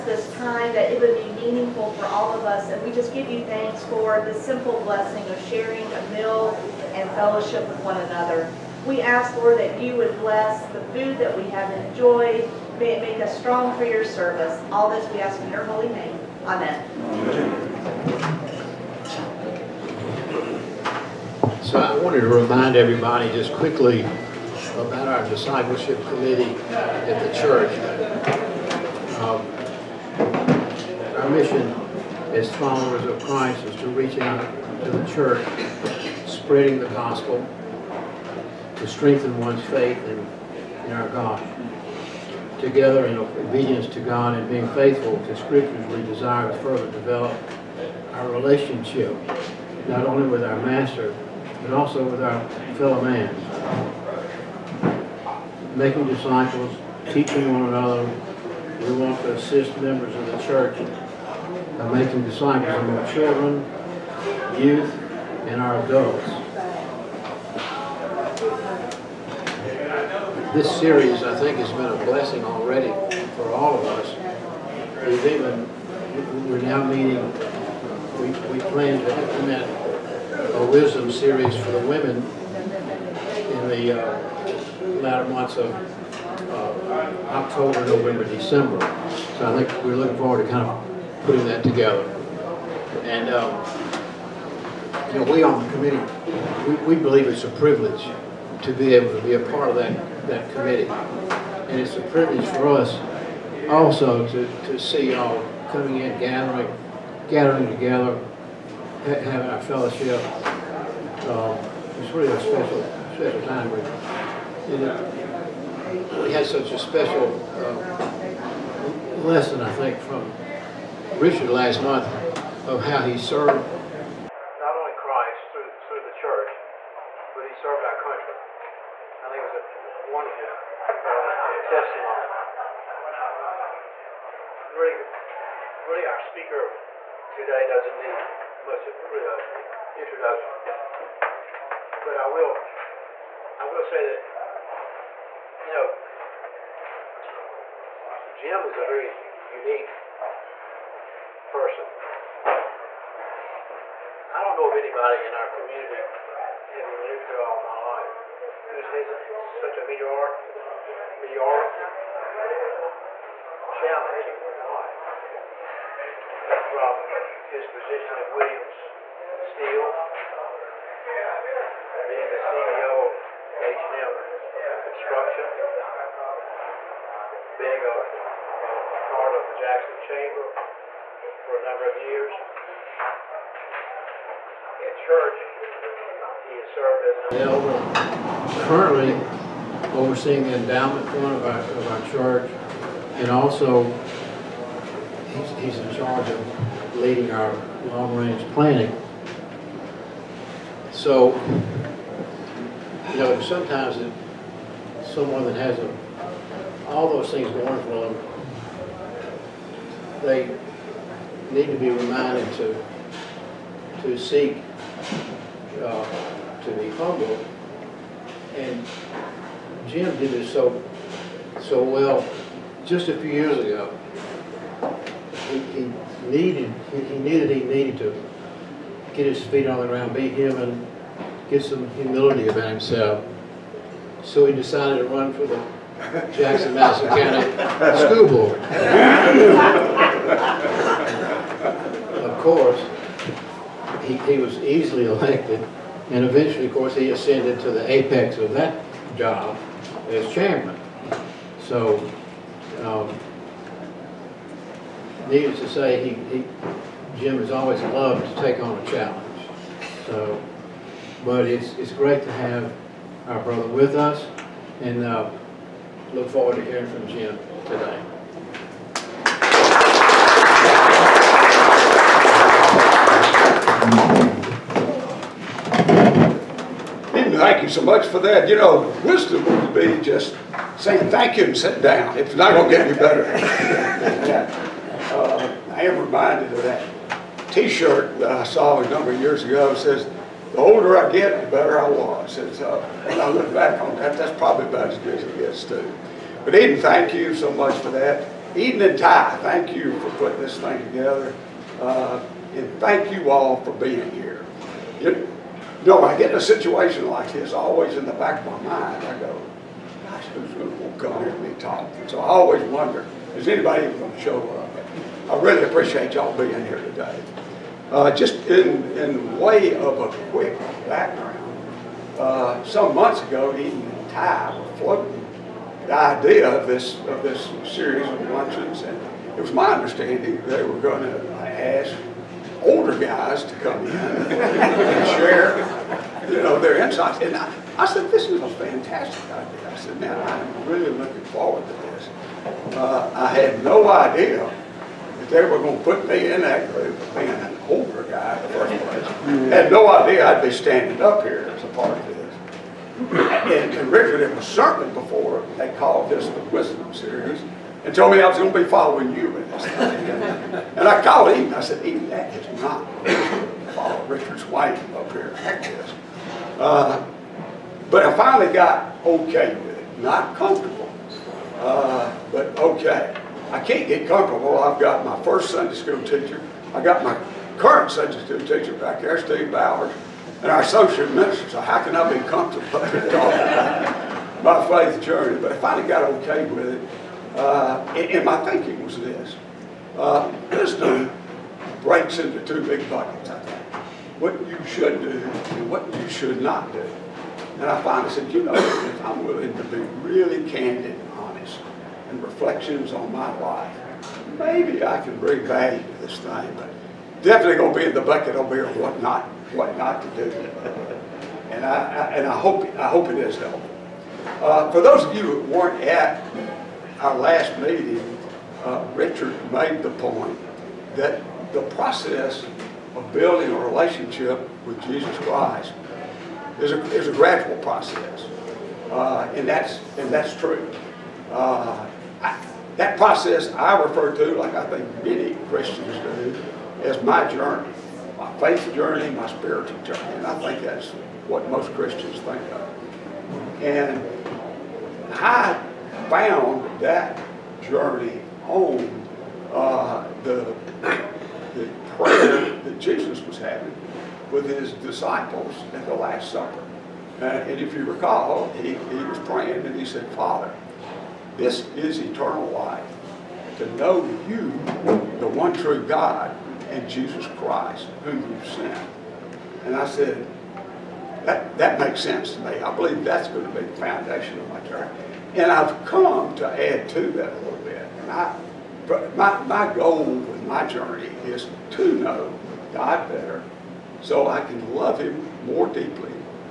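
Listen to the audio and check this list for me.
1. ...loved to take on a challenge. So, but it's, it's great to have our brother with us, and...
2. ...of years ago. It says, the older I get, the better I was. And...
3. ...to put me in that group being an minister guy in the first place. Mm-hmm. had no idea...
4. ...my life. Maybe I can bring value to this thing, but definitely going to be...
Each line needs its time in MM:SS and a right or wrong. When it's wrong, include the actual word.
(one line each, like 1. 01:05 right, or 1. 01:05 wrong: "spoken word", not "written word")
1. 04:17 right
2. 04:49 right
3. 05:45 wrong: "older", not "minister"
4. 06:43 right.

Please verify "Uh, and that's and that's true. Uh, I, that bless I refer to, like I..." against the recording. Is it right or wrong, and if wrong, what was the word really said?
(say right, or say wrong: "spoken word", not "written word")
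wrong: "process", not "bless".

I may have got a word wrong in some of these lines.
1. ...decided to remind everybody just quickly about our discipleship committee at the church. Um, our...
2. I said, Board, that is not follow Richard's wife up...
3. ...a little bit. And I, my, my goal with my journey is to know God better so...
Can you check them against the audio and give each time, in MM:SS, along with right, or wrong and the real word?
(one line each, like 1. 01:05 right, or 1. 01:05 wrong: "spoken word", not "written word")
1. 00:22 wrong: "wanted", not "decided"
2. 06:01 wrong: "Eden", not "Board"
3. 07:57 right.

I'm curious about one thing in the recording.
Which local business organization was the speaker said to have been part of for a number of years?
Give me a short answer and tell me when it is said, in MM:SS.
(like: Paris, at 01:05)
Jackson Chamber, at 02:59.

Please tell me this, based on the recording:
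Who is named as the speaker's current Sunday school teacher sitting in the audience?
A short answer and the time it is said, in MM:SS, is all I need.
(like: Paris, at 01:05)
Steve Bowers, at 06:19.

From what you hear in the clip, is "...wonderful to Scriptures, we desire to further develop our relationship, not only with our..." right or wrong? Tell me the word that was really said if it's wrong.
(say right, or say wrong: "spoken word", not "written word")
wrong: "faithful", not "wonderful".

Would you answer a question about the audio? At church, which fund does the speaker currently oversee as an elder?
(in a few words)
Endowment fund.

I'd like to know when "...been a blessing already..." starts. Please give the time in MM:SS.
01:11.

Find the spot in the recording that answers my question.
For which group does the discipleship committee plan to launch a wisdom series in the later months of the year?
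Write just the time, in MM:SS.
01:21.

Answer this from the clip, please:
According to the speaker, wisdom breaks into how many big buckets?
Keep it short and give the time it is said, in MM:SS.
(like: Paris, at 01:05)
2, at 06:32.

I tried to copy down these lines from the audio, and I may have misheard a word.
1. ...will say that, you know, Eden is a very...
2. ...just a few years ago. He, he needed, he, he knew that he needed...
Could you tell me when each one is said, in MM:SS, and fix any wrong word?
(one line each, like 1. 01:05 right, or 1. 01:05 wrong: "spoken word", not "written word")
1. 02:23 wrong: "Jim", not "Eden"
2. 03:42 right.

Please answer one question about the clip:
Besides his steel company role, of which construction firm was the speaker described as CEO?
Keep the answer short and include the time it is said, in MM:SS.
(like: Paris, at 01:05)
H&M Construction, at 02:53.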